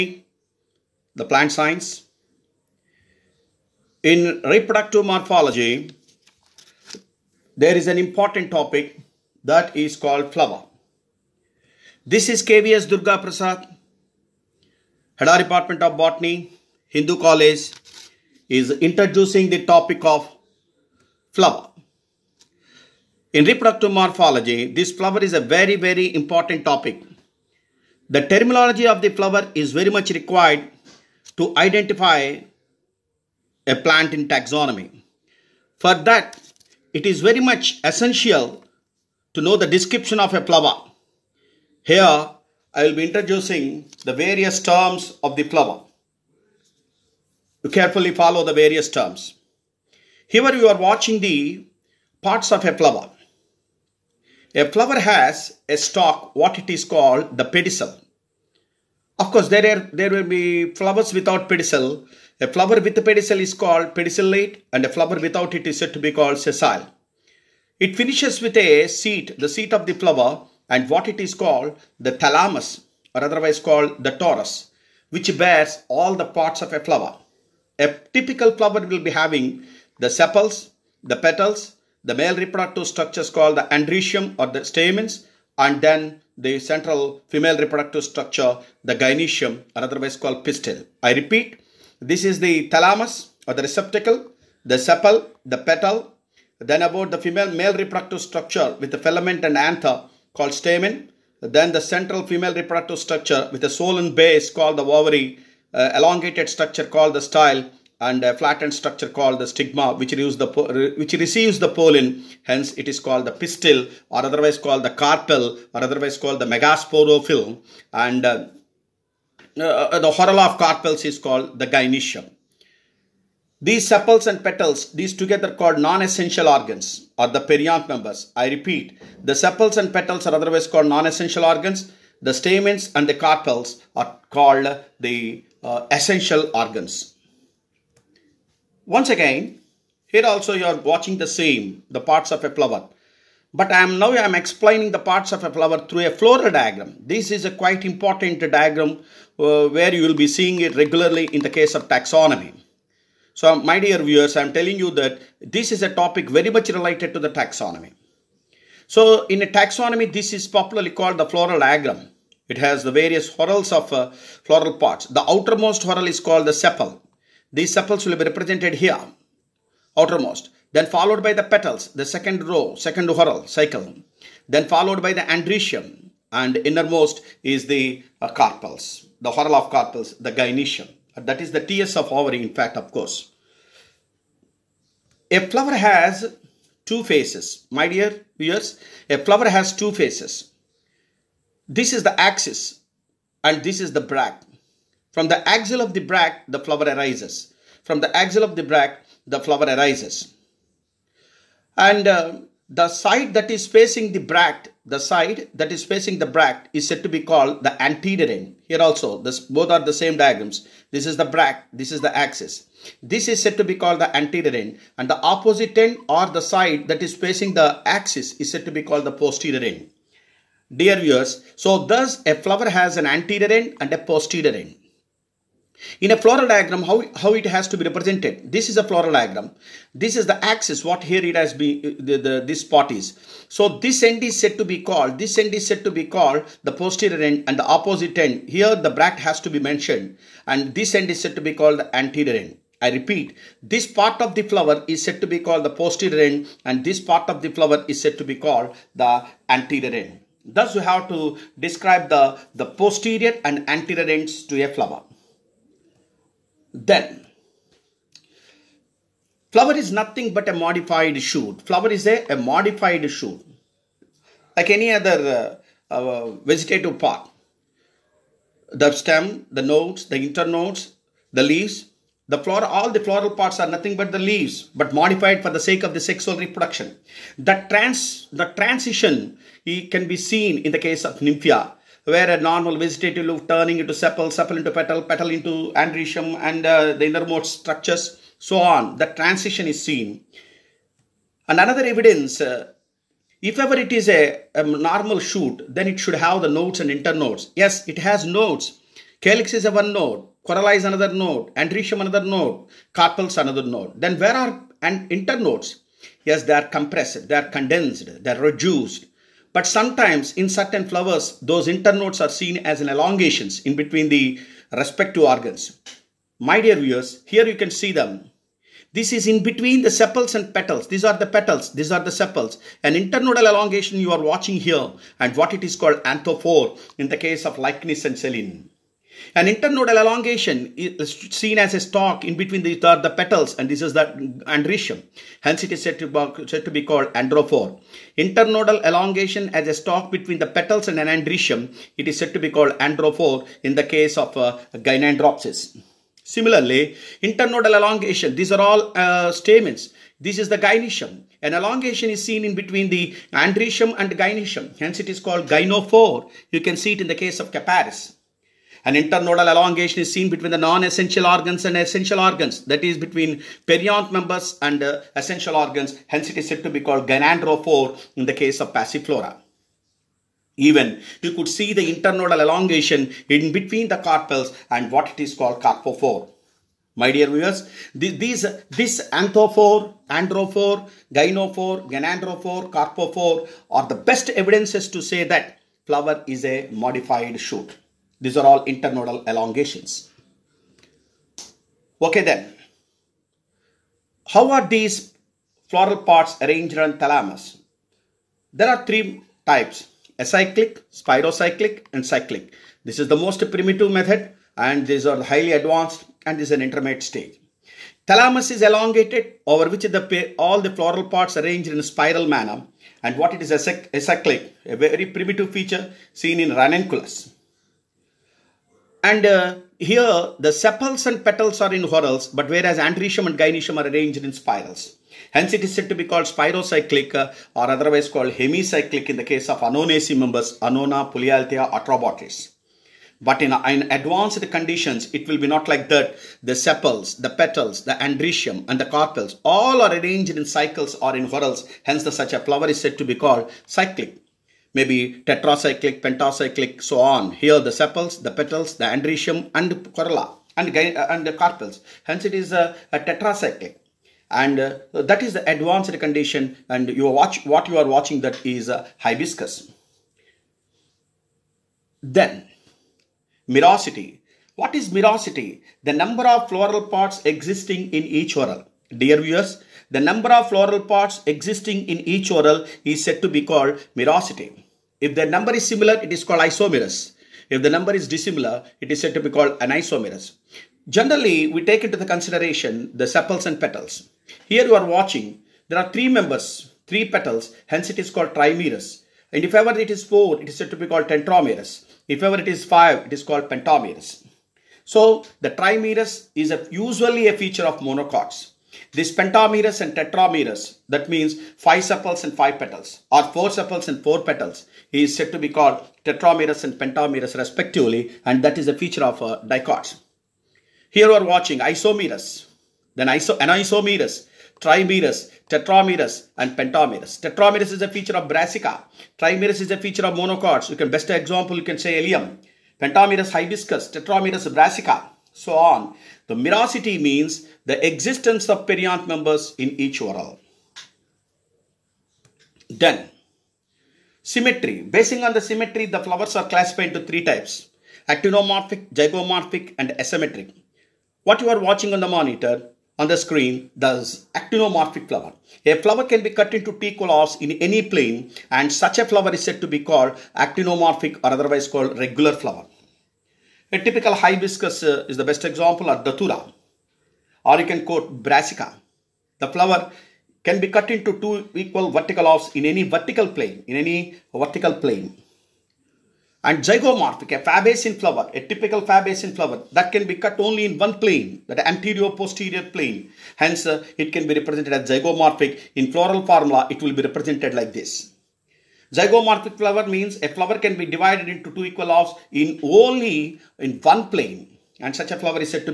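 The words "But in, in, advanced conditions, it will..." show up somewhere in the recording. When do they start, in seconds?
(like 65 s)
433 s.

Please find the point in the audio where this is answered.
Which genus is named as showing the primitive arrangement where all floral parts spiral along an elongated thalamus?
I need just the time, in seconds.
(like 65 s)
416 s.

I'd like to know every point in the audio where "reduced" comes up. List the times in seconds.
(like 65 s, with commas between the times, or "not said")
308 s.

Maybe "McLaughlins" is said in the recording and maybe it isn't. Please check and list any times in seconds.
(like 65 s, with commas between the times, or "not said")
not said.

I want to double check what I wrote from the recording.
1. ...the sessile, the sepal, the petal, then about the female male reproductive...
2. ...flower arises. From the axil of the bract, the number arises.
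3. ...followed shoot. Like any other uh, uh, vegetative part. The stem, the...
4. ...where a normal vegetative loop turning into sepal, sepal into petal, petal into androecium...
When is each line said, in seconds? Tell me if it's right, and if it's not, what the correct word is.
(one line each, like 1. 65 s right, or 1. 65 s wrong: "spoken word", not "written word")
1. 93 s wrong: "receptacle", not "sessile"
2. 196 s wrong: "flower", not "number"
3. 262 s wrong: "modified", not "followed"
4. 282 s right.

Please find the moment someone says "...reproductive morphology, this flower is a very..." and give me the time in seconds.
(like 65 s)
23 s.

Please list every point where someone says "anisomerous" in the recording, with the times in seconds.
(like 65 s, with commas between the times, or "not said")
479 s, 513 s.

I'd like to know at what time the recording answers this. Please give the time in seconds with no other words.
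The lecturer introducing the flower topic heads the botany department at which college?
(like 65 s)
16 s.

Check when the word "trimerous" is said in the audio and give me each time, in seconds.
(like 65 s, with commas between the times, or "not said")
488 s, 495 s, 514 s, 519 s.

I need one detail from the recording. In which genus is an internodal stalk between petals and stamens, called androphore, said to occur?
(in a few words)
Gynandropsis.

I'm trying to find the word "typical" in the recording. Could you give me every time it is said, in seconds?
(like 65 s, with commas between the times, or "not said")
78 s, 553 s, 568 s.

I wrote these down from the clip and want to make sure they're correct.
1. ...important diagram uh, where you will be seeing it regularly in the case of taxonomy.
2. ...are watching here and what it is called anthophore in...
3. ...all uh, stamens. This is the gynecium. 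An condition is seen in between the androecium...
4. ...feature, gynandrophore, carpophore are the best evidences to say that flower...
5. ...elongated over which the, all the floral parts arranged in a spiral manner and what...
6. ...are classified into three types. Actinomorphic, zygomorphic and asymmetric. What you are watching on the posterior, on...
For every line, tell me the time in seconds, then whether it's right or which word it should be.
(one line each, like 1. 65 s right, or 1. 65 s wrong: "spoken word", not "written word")
1. 147 s right
2. 324 s right
3. 348 s wrong: "elongation", not "condition"
4. 381 s wrong: "gynophore", not "feature"
5. 408 s right
6. 536 s wrong: "monitor", not "posterior".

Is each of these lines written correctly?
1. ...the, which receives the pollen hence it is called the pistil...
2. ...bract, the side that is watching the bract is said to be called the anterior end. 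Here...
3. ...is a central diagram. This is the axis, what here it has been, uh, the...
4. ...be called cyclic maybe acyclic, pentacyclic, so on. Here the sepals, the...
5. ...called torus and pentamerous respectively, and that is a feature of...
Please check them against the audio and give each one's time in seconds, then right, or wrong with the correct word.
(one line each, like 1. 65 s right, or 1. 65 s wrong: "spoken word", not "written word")
1. 110 s right
2. 204 s wrong: "facing", not "watching"
3. 228 s wrong: "floral", not "central"
4. 443 s wrong: "tetracyclic", not "acyclic"
5. 505 s wrong: "tetramerous", not "torus".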